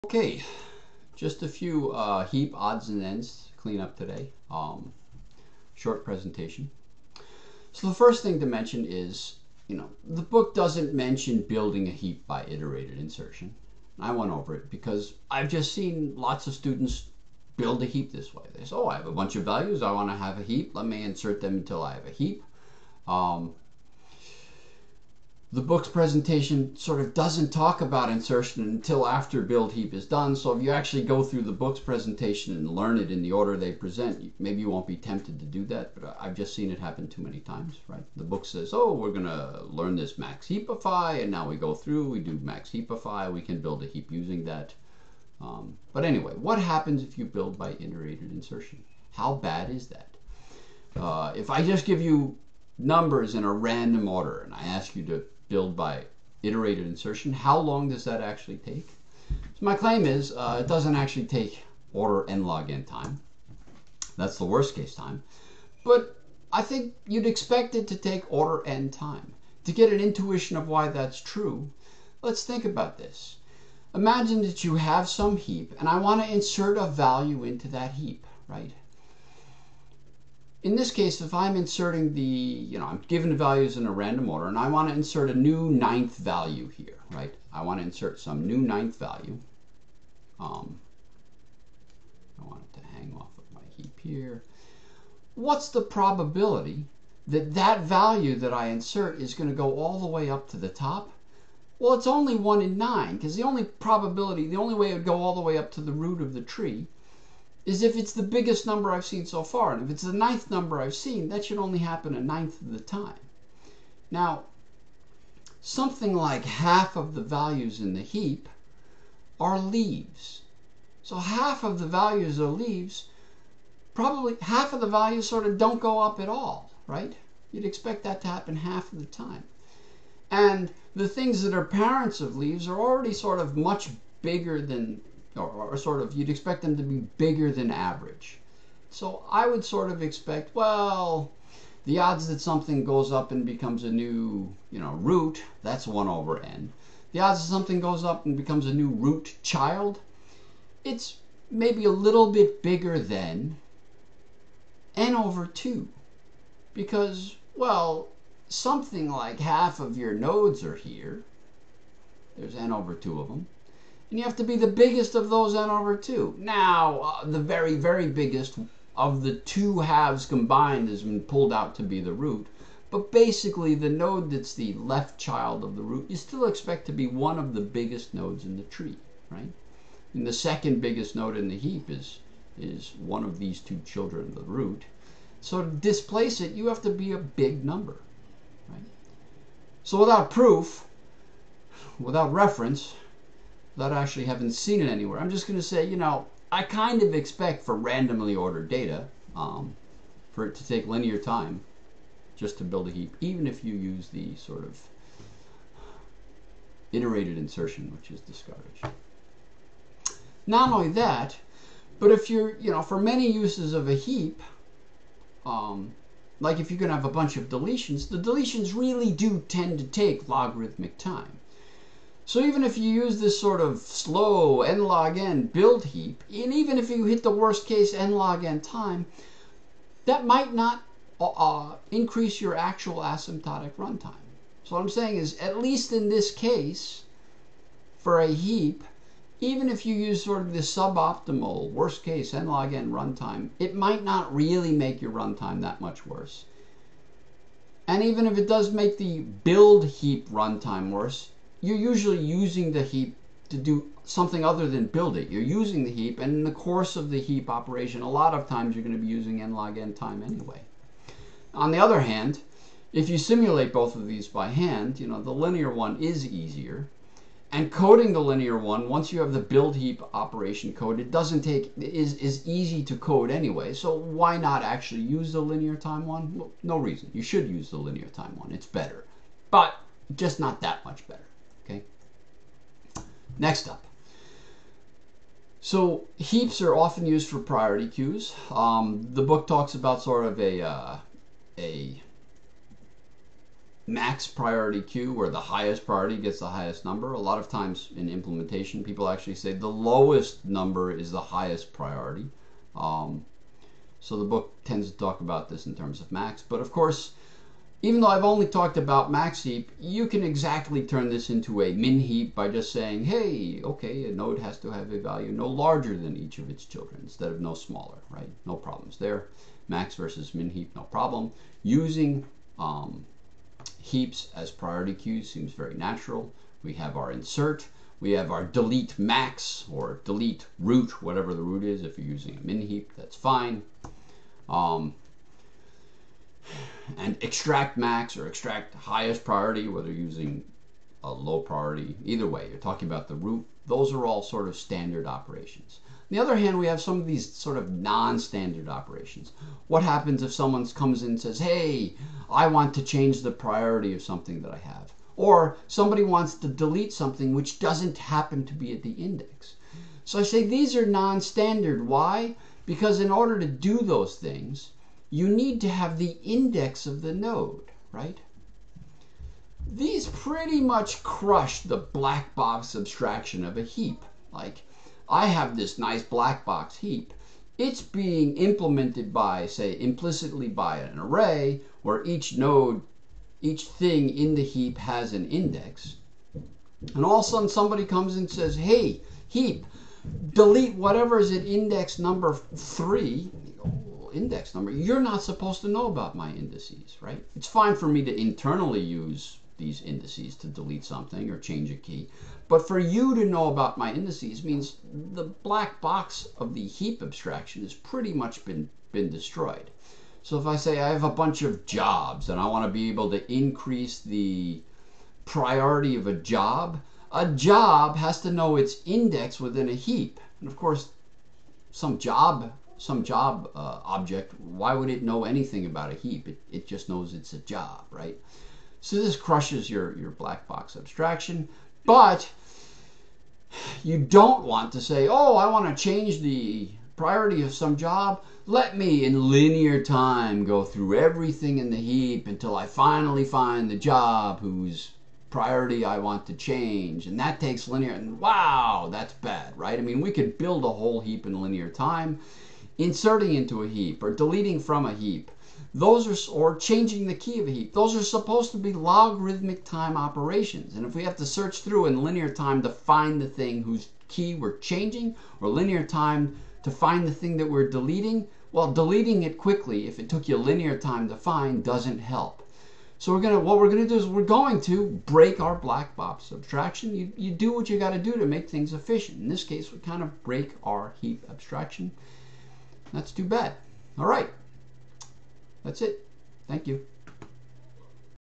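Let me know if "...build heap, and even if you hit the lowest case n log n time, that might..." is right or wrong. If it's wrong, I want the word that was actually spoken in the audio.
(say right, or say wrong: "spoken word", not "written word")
wrong: "worst", not "lowest".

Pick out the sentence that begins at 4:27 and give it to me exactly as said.
And coding the linear one, once you have the build heap operation code, it doesn't take, is, is easy to code anyway.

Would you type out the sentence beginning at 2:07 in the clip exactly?
You'd expect that to happen half of the time.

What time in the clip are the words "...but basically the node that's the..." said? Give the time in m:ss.
2:52.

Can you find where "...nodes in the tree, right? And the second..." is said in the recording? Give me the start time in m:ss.
2:58.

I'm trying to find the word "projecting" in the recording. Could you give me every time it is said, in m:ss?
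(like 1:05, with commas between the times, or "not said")
not said.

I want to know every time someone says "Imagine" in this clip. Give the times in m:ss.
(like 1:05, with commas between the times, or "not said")
1:13.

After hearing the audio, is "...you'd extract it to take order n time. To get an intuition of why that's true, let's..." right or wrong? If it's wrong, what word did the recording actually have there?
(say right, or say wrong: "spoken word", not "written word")
wrong: "expect", not "extract".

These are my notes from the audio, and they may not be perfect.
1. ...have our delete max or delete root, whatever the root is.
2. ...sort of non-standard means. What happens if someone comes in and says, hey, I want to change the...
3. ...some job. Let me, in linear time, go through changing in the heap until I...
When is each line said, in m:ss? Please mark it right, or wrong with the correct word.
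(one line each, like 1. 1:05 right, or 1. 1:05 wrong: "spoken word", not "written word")
1. 5:28 right
2. 5:47 wrong: "operations", not "means"
3. 7:17 wrong: "everything", not "changing".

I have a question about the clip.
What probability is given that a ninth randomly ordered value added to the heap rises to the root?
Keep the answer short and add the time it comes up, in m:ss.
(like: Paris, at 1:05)
1 in 9, at 1:42.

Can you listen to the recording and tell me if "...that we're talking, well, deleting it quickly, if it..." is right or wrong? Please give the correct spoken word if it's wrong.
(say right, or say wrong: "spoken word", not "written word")
wrong: "deleting", not "talking".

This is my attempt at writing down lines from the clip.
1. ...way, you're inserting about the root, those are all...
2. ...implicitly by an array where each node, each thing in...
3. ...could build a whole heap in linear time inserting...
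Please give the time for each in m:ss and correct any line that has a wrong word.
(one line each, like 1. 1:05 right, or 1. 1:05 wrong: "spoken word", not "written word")
1. 5:42 wrong: "talking", not "inserting"
2. 6:19 right
3. 7:30 right.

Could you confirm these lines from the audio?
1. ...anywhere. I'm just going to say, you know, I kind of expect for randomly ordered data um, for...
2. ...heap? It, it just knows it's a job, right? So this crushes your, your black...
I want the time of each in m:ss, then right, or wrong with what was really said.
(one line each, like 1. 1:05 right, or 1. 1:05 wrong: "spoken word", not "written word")
1. 3:14 right
2. 7:05 right.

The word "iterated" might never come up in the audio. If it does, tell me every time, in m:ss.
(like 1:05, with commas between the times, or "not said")
0:12, 0:47, 0:56, 3:26.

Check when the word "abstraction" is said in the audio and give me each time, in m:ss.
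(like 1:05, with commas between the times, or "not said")
6:12, 6:47, 7:10, 7:56, 8:01.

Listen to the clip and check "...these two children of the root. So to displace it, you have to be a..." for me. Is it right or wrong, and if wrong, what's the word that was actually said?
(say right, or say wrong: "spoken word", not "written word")
right.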